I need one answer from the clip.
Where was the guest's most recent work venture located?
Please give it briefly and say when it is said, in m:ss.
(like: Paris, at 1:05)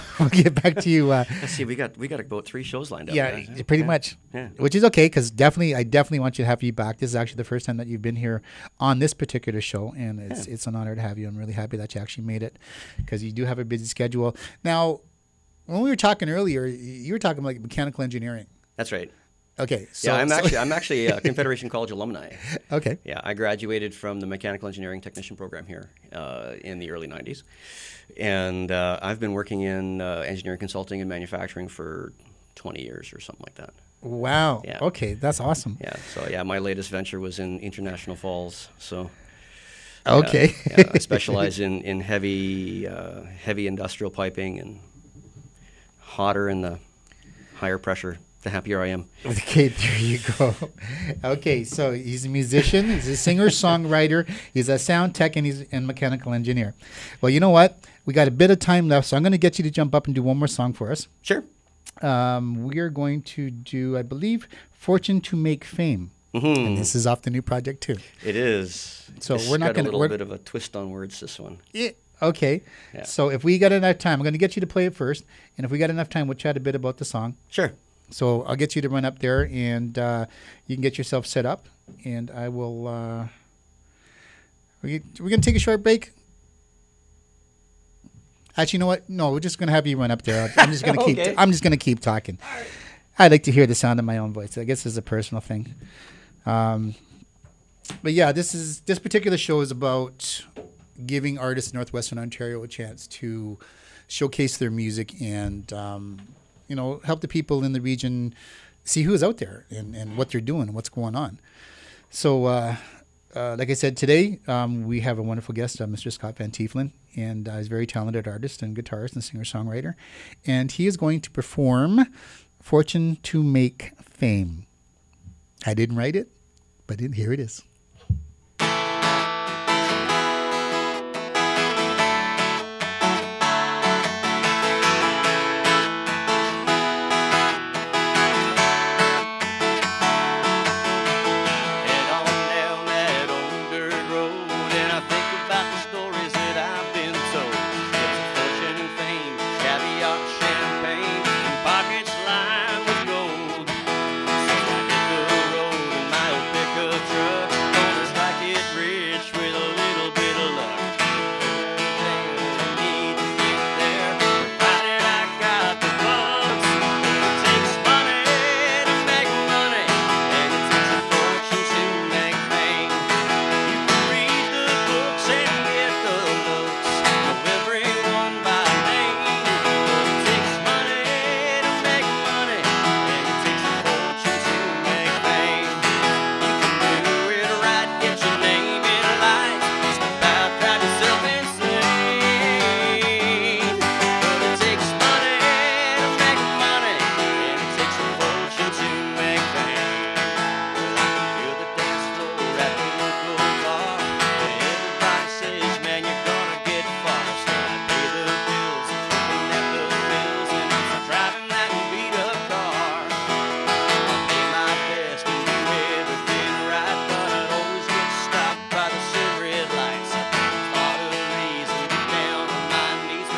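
International Falls, at 0:37.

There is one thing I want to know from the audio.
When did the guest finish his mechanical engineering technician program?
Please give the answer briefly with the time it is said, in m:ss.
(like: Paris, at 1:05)
early '90s, at 0:26.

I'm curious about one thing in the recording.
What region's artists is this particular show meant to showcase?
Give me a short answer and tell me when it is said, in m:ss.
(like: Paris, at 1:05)
Northwestern Ontario, at 1:41.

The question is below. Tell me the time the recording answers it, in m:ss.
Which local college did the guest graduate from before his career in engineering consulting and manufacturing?
0:21.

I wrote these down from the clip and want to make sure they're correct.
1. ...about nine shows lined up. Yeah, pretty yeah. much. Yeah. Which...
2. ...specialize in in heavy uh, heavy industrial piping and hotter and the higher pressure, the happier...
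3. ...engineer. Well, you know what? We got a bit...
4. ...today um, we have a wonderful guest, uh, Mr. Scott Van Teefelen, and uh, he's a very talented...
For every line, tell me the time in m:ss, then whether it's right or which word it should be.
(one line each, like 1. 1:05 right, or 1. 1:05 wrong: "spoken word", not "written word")
1. 0:02 wrong: "three", not "nine"
2. 0:40 right
3. 0:56 right
4. 1:53 right.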